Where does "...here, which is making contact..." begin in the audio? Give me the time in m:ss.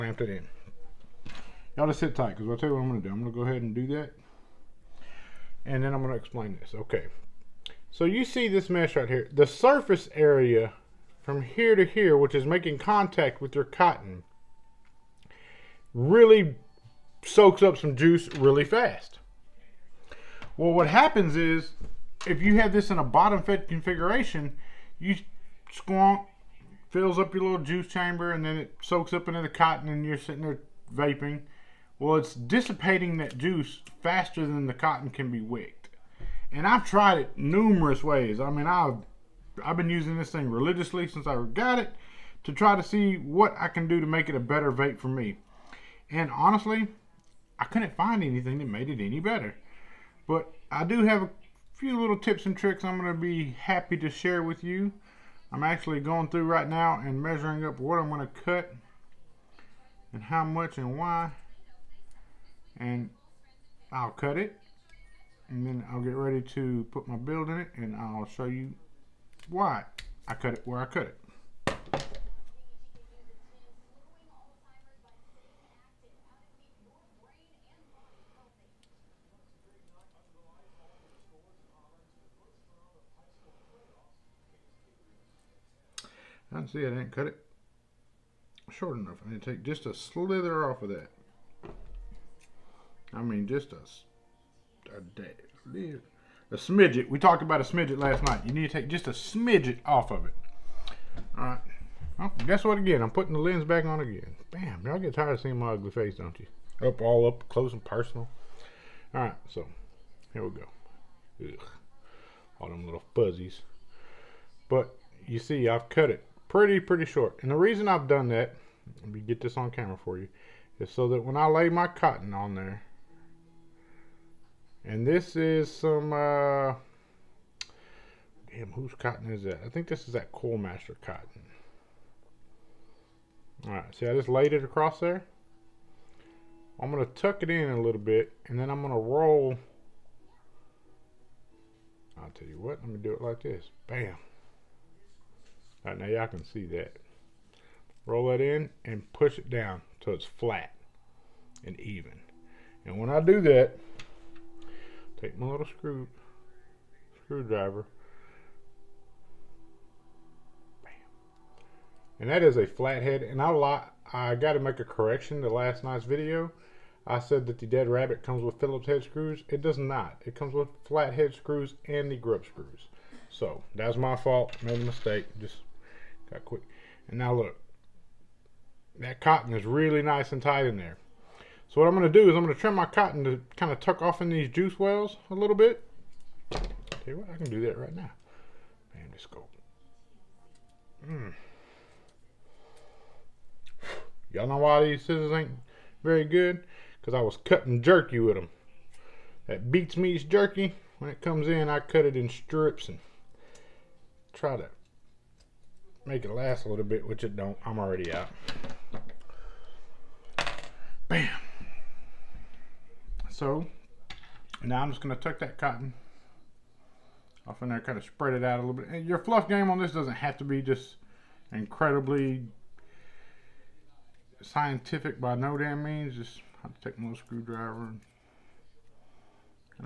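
0:11.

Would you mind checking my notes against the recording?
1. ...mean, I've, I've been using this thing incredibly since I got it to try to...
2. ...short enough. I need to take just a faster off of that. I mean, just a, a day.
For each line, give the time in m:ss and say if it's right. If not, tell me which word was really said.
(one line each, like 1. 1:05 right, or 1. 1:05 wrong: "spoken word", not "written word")
1. 0:38 wrong: "religiously", not "incredibly"
2. 1:28 wrong: "slither", not "faster".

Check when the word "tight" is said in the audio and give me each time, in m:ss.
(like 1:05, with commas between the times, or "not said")
0:02, 3:00.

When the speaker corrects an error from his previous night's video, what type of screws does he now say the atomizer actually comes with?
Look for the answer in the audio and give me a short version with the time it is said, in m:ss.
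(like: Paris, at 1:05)
flathead screws, at 2:50.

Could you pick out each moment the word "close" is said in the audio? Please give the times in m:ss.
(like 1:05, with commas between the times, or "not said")
1:47.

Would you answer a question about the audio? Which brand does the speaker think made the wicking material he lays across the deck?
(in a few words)
Coil Master.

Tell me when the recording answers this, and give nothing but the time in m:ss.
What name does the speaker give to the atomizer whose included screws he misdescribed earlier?
2:47.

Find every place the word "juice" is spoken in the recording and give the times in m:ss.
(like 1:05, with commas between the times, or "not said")
0:17, 0:27, 0:33, 3:04.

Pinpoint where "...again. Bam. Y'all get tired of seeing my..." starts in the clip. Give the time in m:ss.
1:43.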